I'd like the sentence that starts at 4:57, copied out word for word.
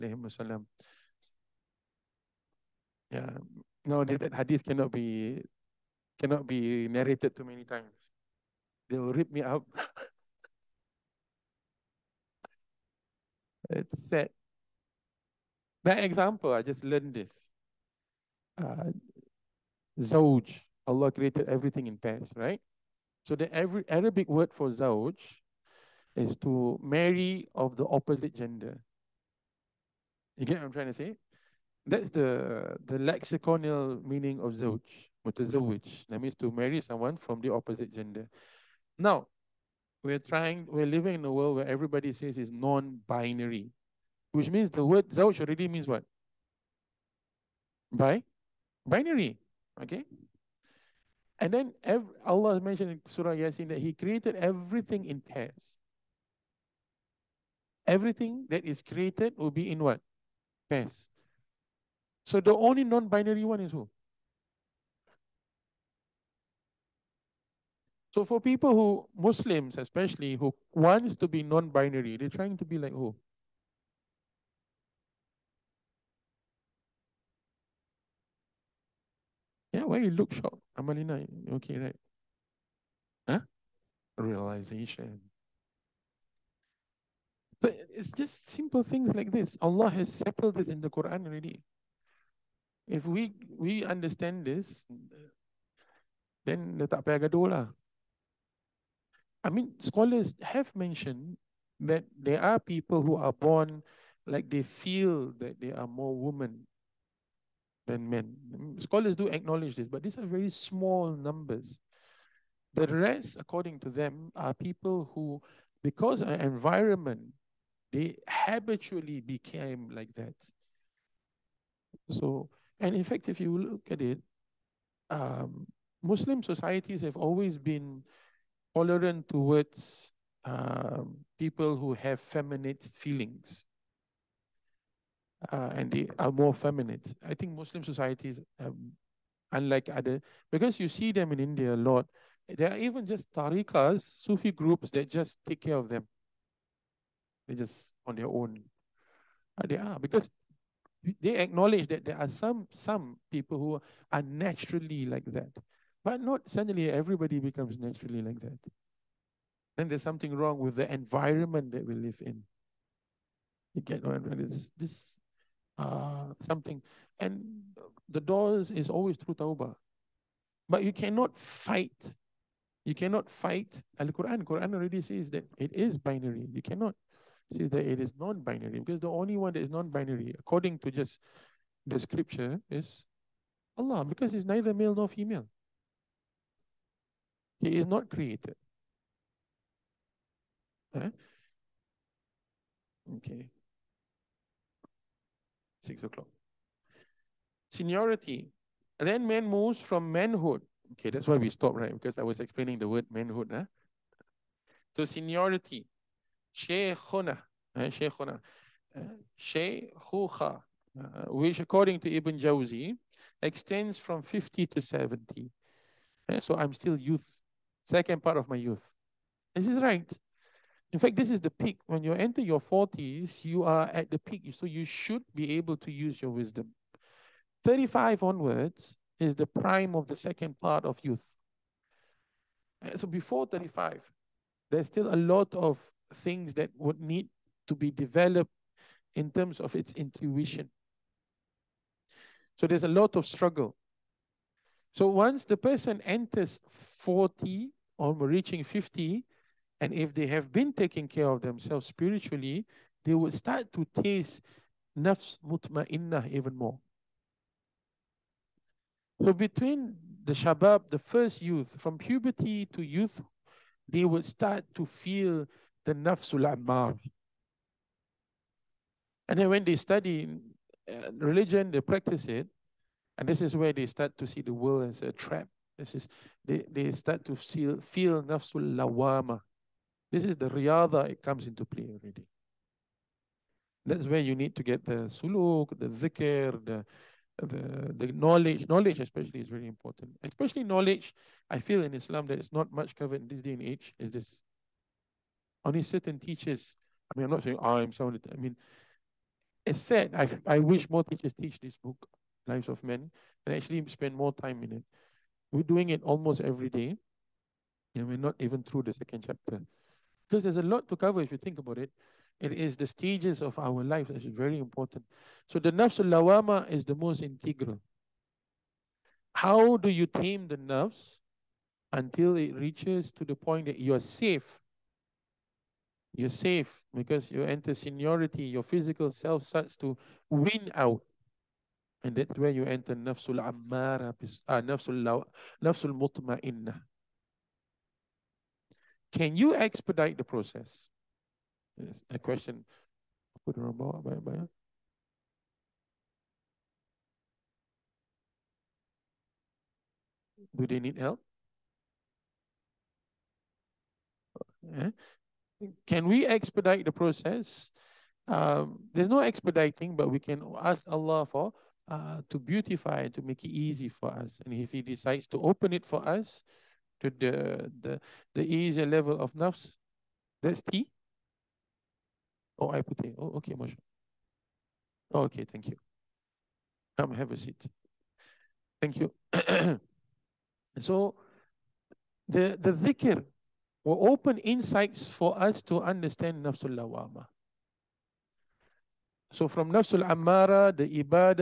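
I mean, I'm not saying I'm someone.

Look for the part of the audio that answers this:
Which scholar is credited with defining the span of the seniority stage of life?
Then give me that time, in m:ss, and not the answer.
3:32.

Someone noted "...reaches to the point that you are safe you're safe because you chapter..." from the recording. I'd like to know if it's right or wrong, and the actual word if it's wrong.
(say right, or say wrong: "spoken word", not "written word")
wrong: "enter", not "chapter".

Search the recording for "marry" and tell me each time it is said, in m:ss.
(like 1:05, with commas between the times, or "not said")
0:26, 0:36.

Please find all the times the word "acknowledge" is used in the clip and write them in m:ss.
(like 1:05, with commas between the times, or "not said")
1:49, 2:31.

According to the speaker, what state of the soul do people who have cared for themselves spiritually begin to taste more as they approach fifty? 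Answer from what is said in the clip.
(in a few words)
nafs mutma'innah.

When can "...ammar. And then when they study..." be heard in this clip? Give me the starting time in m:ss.
4:26.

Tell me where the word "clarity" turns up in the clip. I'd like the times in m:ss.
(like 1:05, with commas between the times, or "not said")
not said.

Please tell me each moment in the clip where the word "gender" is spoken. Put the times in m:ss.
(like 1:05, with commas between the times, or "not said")
0:28, 0:37.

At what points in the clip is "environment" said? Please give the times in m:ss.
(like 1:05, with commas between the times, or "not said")
1:56, 2:40.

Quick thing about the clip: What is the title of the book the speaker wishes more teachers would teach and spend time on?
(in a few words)
Lives of Men.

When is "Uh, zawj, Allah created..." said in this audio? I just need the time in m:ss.
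0:18.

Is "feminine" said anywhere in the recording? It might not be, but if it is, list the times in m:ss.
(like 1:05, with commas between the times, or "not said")
2:12, 2:16.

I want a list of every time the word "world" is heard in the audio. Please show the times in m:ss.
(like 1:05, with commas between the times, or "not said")
0:41, 4:34.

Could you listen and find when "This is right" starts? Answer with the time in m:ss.
3:39.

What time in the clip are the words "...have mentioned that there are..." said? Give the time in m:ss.
1:40.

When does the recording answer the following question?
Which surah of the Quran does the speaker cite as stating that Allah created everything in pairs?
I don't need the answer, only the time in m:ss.
0:53.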